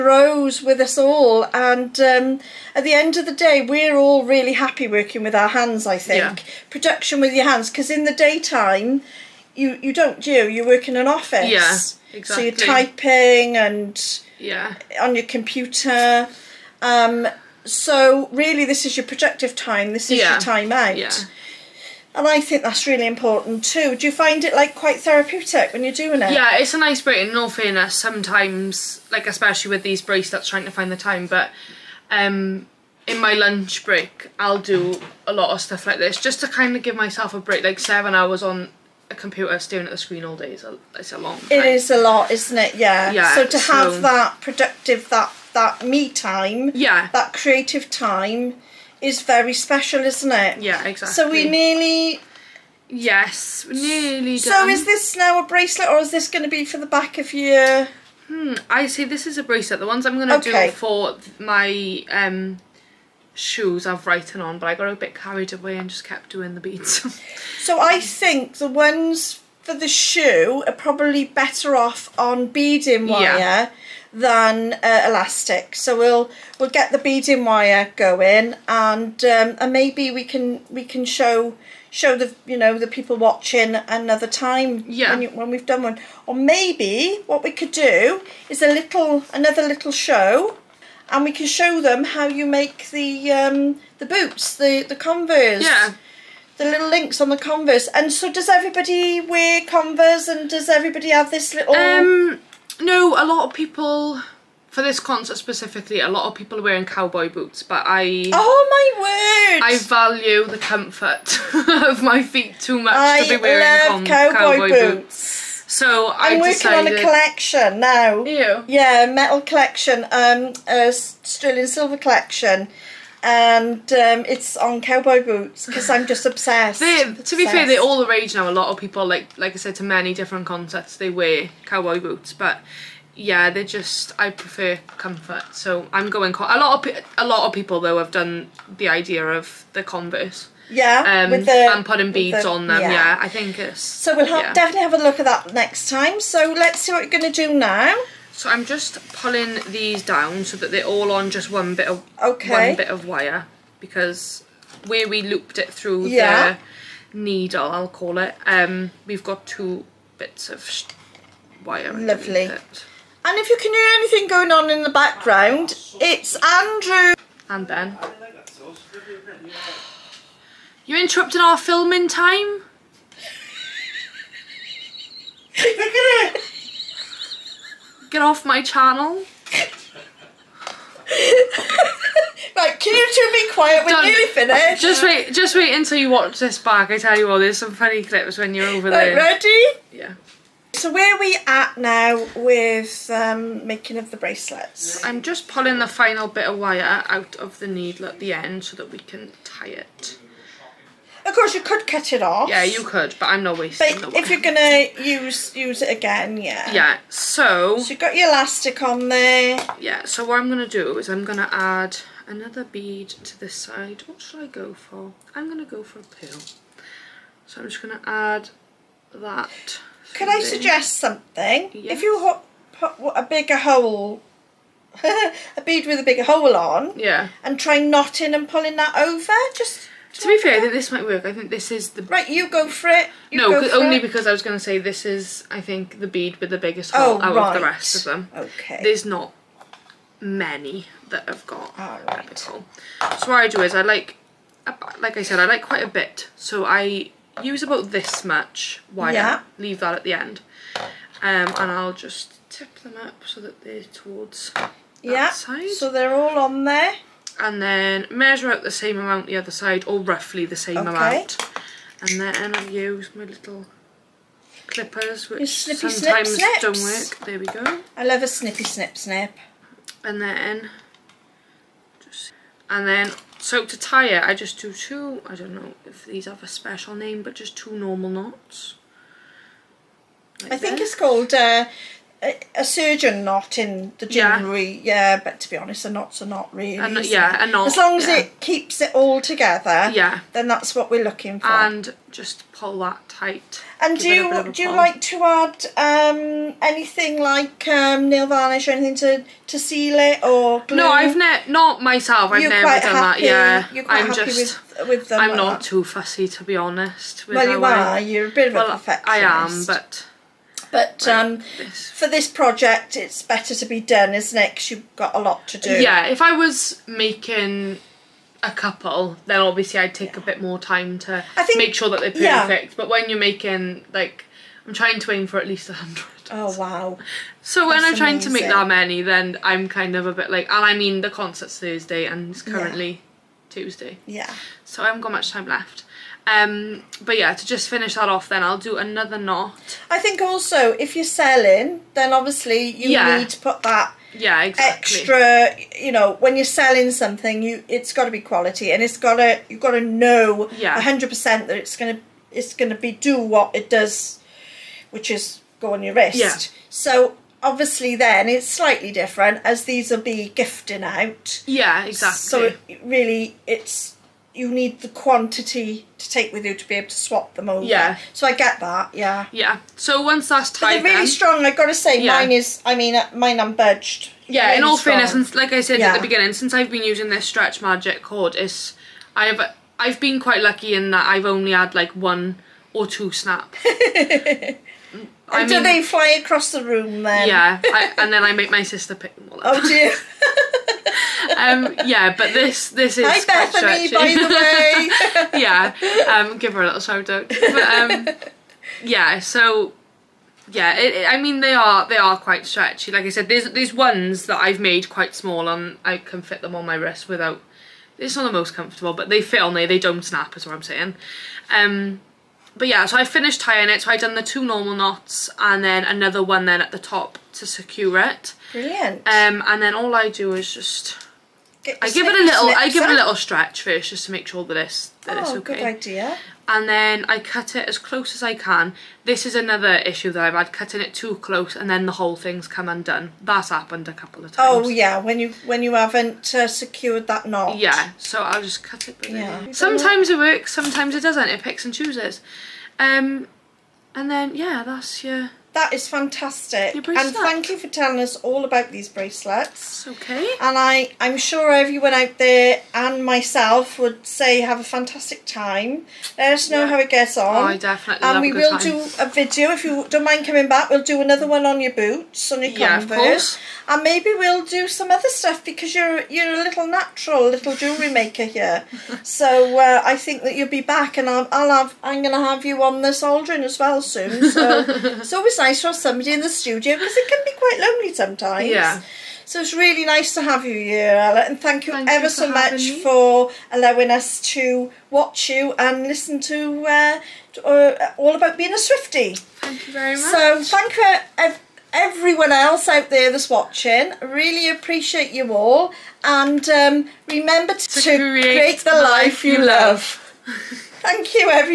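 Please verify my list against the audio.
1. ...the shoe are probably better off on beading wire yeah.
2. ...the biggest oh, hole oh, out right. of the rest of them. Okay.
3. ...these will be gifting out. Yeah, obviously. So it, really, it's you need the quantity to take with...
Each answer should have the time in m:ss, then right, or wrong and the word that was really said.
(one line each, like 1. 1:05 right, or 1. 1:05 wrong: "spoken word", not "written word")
1. 1:09 right
2. 3:56 right
3. 5:59 wrong: "exactly", not "obviously".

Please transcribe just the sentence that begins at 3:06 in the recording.
I tell you all there's some funny clips when you're over right, there.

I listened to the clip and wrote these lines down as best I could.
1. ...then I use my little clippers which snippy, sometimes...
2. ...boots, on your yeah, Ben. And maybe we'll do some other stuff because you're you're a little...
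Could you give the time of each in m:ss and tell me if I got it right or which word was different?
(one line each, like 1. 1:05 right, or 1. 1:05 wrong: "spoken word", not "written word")
1. 4:22 right
2. 7:41 wrong: "Converse", not "Ben".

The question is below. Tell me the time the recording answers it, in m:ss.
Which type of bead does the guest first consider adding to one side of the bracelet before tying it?
3:36.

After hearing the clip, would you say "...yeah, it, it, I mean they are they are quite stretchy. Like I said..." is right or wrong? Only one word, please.
right.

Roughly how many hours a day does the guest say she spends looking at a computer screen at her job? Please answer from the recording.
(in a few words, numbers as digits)
7.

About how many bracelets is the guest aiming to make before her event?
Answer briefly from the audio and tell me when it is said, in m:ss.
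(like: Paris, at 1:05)
100, at 5:25.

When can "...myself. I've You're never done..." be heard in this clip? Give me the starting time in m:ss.
5:01.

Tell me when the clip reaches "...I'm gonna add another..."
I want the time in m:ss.
3:31.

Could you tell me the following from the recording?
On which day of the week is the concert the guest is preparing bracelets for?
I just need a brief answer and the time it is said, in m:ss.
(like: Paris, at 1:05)
Thursday, at 5:31.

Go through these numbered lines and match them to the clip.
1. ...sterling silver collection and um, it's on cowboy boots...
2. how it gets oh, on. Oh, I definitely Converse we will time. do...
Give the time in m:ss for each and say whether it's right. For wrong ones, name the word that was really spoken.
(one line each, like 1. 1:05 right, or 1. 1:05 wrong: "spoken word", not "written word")
1. 2:00 right
2. 7:36 wrong: "And", not "Converse".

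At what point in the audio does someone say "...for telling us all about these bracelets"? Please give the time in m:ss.
7:27.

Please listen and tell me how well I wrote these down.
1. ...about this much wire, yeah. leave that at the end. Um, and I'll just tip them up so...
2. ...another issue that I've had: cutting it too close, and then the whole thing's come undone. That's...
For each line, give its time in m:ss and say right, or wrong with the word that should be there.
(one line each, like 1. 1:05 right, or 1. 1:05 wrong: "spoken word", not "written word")
1. 4:07 right
2. 7:09 right.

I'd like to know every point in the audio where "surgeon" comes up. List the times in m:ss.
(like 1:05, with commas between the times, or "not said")
4:42.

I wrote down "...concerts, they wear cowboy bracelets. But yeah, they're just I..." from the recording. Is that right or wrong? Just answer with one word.
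wrong.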